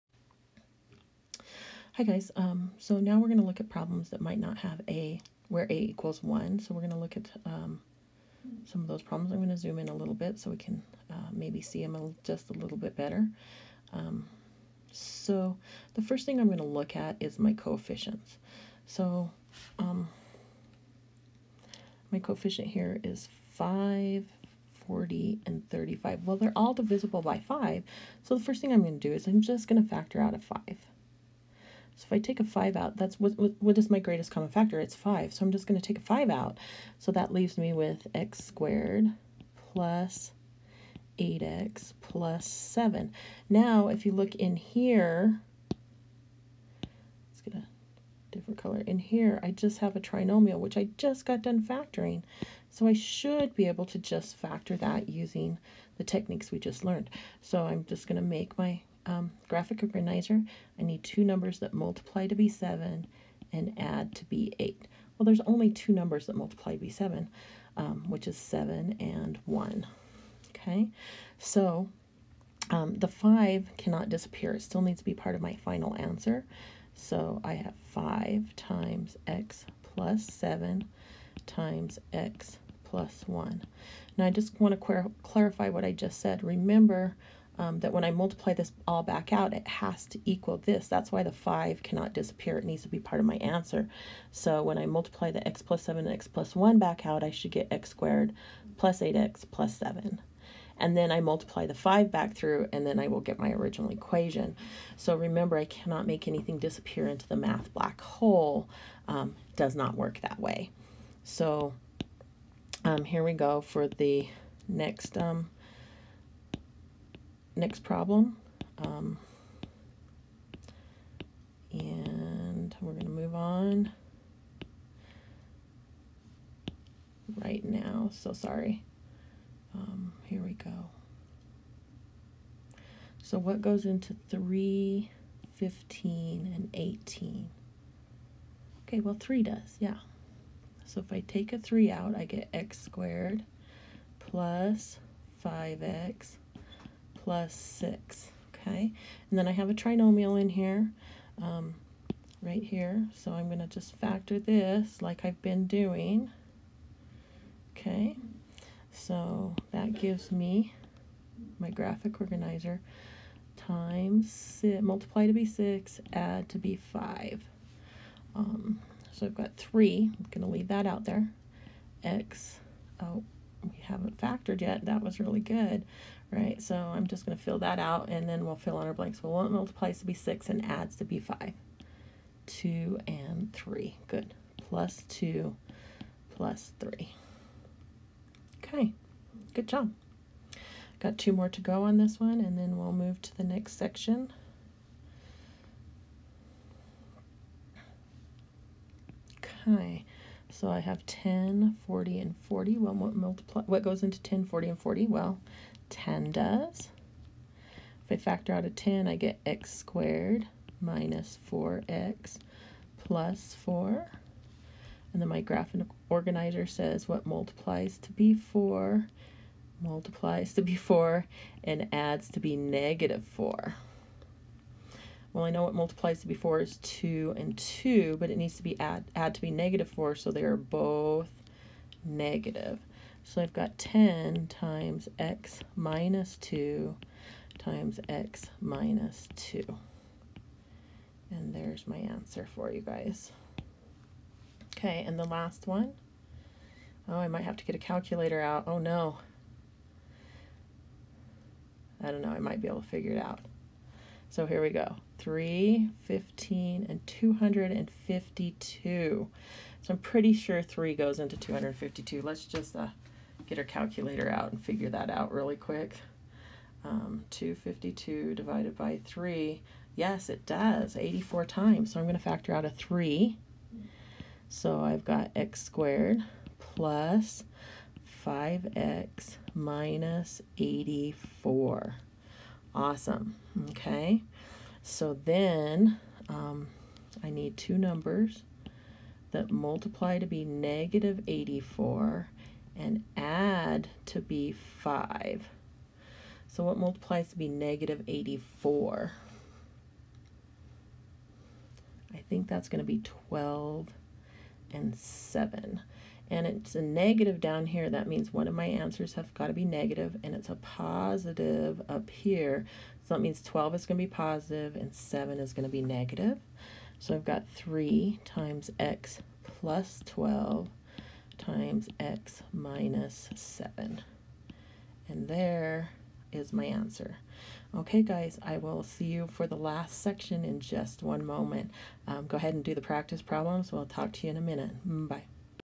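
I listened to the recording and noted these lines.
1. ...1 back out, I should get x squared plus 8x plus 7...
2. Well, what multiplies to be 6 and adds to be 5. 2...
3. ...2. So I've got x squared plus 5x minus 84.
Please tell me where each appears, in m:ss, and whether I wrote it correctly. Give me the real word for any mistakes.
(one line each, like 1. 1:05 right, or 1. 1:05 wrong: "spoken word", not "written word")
1. 1:36 right
2. 2:59 right
3. 4:32 wrong: "3", not "2".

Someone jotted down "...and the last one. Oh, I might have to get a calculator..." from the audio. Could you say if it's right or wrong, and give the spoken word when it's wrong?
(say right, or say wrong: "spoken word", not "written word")
right.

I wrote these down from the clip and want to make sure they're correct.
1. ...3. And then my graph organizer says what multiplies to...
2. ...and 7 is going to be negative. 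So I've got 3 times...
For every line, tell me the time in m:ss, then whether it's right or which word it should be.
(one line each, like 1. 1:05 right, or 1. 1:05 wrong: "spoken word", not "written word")
1. 3:33 wrong: "4", not "3"
2. 5:14 right.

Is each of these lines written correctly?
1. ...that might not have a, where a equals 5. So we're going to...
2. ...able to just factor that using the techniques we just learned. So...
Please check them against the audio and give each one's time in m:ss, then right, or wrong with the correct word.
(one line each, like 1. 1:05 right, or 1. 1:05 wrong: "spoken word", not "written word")
1. 0:04 wrong: "1", not "5"
2. 0:53 right.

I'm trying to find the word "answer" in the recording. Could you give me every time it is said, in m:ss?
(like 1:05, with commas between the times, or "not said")
1:15, 1:33, 4:01, 5:08, 5:26.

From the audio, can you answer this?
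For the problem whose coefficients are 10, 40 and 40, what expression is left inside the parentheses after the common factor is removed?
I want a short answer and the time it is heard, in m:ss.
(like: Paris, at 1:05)
x squared minus 4x plus 4, at 3:29.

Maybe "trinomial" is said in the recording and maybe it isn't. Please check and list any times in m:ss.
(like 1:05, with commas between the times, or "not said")
0:49, 2:29.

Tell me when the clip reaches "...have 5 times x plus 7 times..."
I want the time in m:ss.
1:17.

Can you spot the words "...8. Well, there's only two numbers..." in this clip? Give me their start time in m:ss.
1:04.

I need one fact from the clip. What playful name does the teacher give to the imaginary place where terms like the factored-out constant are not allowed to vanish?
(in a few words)
math black hole.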